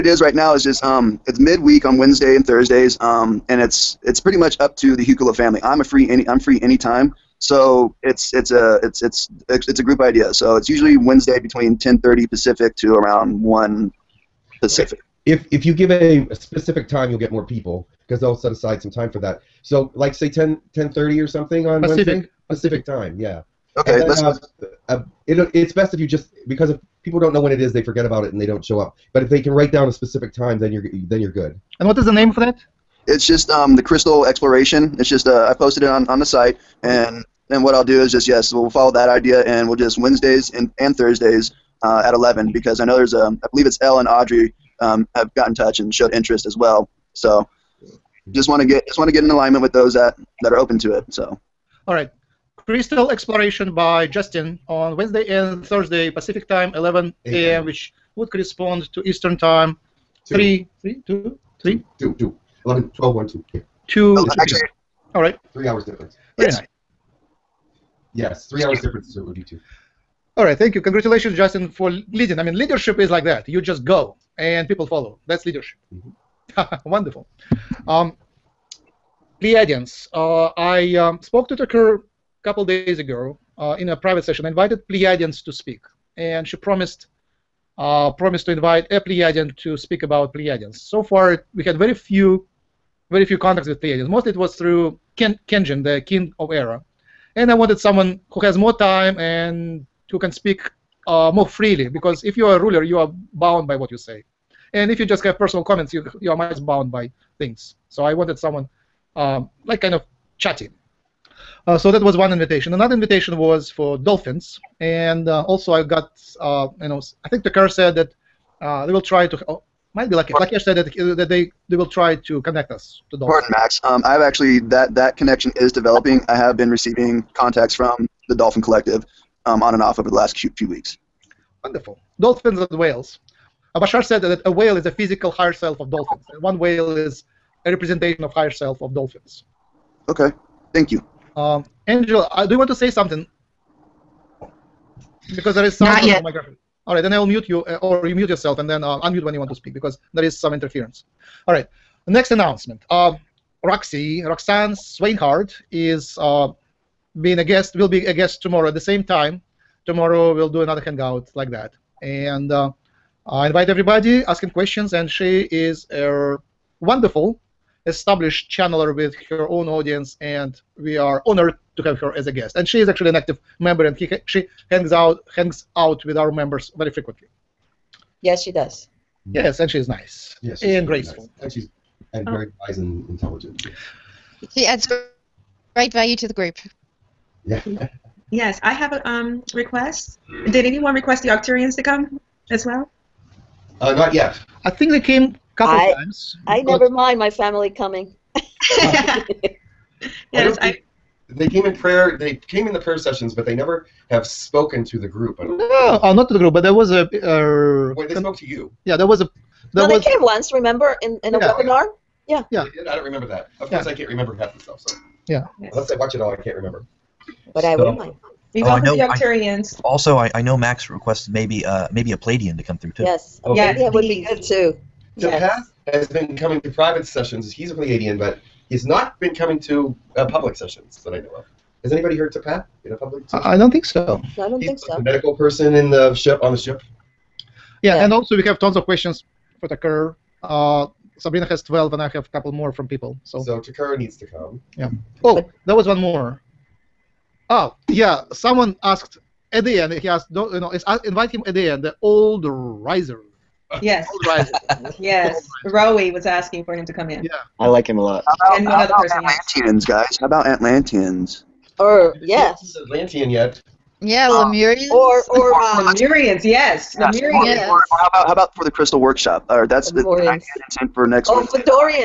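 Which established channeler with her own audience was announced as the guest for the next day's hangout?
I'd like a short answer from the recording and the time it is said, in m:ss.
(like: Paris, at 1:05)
Roxanne Swainhart, at 2:34.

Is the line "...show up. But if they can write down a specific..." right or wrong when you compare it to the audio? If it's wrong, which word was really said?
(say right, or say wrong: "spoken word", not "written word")
right.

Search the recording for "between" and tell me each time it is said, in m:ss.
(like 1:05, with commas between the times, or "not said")
0:11.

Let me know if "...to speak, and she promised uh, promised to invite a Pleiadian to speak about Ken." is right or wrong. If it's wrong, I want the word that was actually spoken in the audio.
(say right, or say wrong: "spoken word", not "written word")
wrong: "Pleiadians", not "Ken".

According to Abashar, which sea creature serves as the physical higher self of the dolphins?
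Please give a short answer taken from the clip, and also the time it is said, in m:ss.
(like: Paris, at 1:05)
A whale, at 2:14.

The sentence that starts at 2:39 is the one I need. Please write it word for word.
Tomorrow we'll do another hangout like that.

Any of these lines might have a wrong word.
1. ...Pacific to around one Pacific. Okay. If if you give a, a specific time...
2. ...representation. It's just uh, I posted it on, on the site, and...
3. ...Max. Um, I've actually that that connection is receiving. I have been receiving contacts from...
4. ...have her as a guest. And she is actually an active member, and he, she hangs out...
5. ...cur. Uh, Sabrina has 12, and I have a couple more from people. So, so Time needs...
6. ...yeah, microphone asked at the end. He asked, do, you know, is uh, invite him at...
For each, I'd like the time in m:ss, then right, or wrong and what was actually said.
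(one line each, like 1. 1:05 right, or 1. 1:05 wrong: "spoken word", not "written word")
1. 0:12 right
2. 0:34 wrong: "exploration", not "representation"
3. 2:03 wrong: "developing", not "receiving"
4. 2:51 right
5. 3:59 wrong: "Tekkrr", not "Time"
6. 4:07 wrong: "someone", not "microphone".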